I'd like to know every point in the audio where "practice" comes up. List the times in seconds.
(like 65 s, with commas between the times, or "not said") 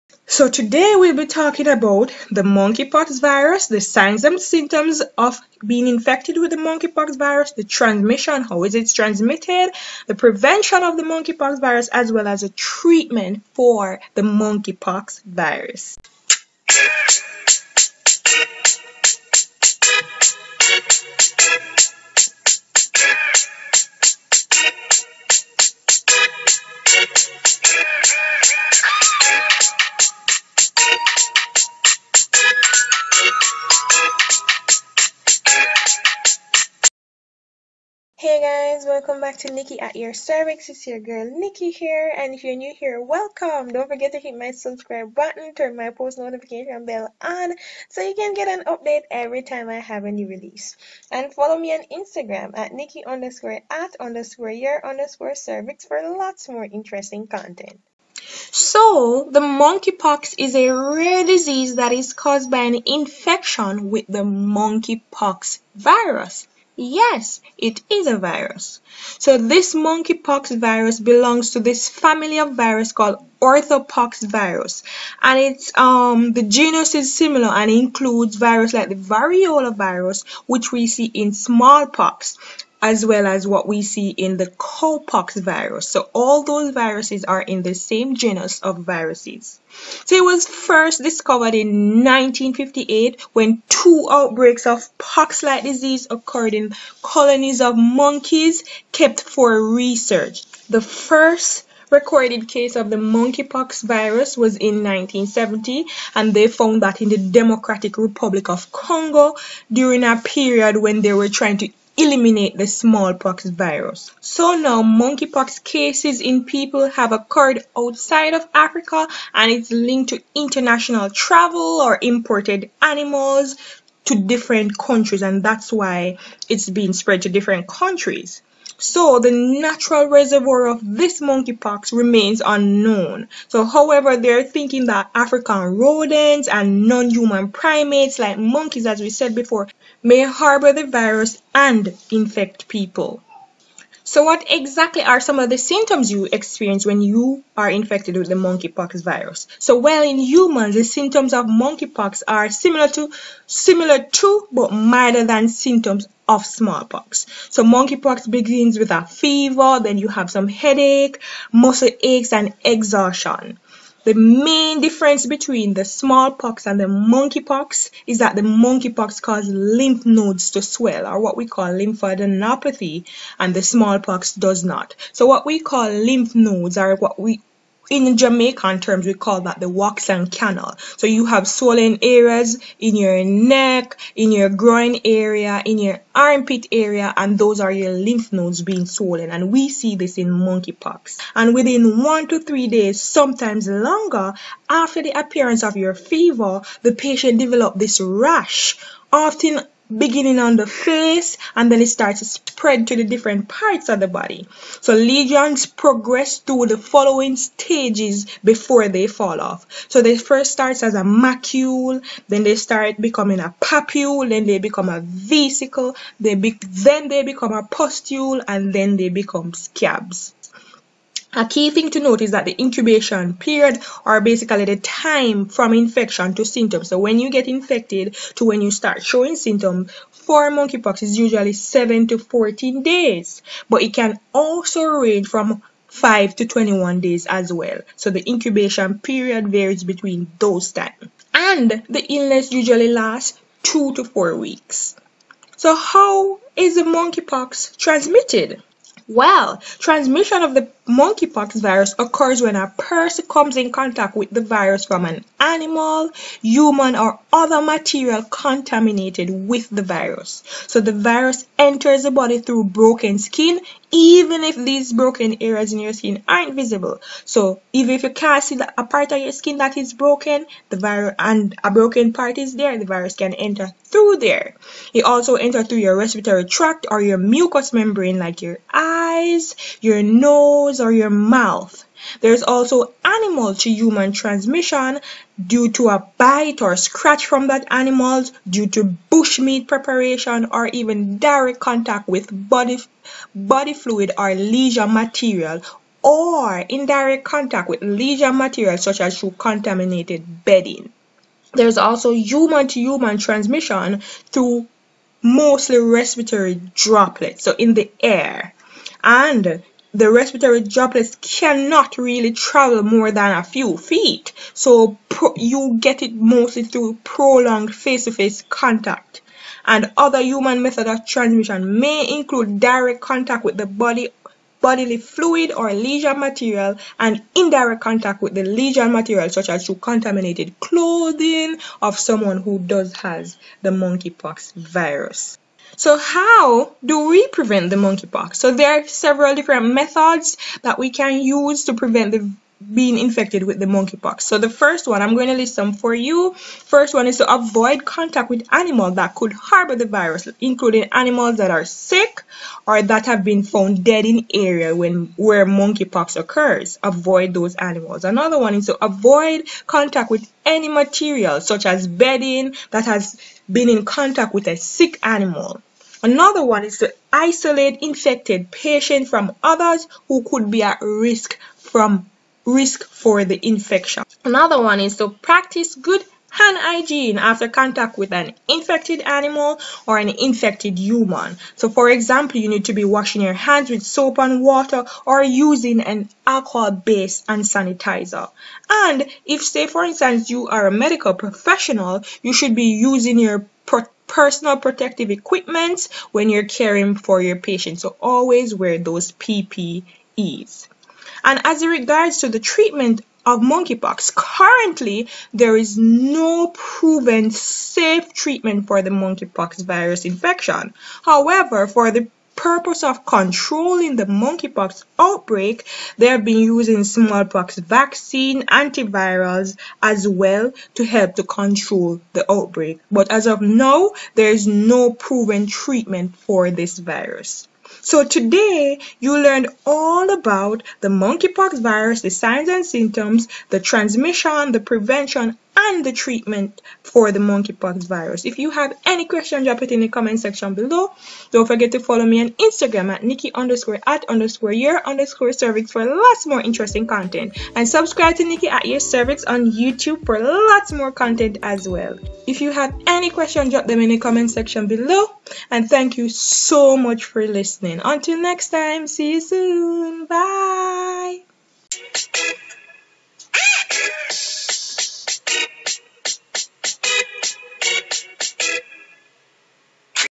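375 s.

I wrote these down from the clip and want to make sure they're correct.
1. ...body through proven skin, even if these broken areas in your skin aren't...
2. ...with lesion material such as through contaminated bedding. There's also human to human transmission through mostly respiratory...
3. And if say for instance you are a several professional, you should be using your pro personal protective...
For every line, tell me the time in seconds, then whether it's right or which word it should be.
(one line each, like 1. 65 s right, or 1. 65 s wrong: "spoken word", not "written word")
1. 262 s wrong: "broken", not "proven"
2. 297 s right
3. 388 s wrong: "medical", not "several".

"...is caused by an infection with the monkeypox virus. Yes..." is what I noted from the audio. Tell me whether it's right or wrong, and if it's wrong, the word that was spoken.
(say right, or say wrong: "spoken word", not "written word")
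right.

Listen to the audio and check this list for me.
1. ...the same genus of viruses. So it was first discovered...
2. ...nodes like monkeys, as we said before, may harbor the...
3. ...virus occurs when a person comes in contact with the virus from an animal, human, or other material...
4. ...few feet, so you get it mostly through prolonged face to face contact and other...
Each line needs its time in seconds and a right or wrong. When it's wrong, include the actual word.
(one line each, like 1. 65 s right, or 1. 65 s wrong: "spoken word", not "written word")
1. 87 s right
2. 137 s wrong: "primates", not "nodes"
3. 251 s right
4. 313 s right.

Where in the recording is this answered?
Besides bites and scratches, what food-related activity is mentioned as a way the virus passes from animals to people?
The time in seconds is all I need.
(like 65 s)
289 s.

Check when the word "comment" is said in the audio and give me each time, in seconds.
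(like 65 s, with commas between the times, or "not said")
439 s, 453 s.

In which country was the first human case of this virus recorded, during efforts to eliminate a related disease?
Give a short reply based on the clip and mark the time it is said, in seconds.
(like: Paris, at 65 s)
Democratic Republic of Congo, at 107 s.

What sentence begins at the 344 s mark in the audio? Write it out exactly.
So the first one, I'm going to list some for you.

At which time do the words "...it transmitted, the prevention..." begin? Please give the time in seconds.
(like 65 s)
8 s.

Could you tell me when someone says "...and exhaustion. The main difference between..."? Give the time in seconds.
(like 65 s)
162 s.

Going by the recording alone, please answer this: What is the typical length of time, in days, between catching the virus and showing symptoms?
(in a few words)
7 to 14 days.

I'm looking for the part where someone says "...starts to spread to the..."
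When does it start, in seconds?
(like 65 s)
201 s.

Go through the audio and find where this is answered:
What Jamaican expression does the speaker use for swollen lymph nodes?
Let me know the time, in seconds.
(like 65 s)
179 s.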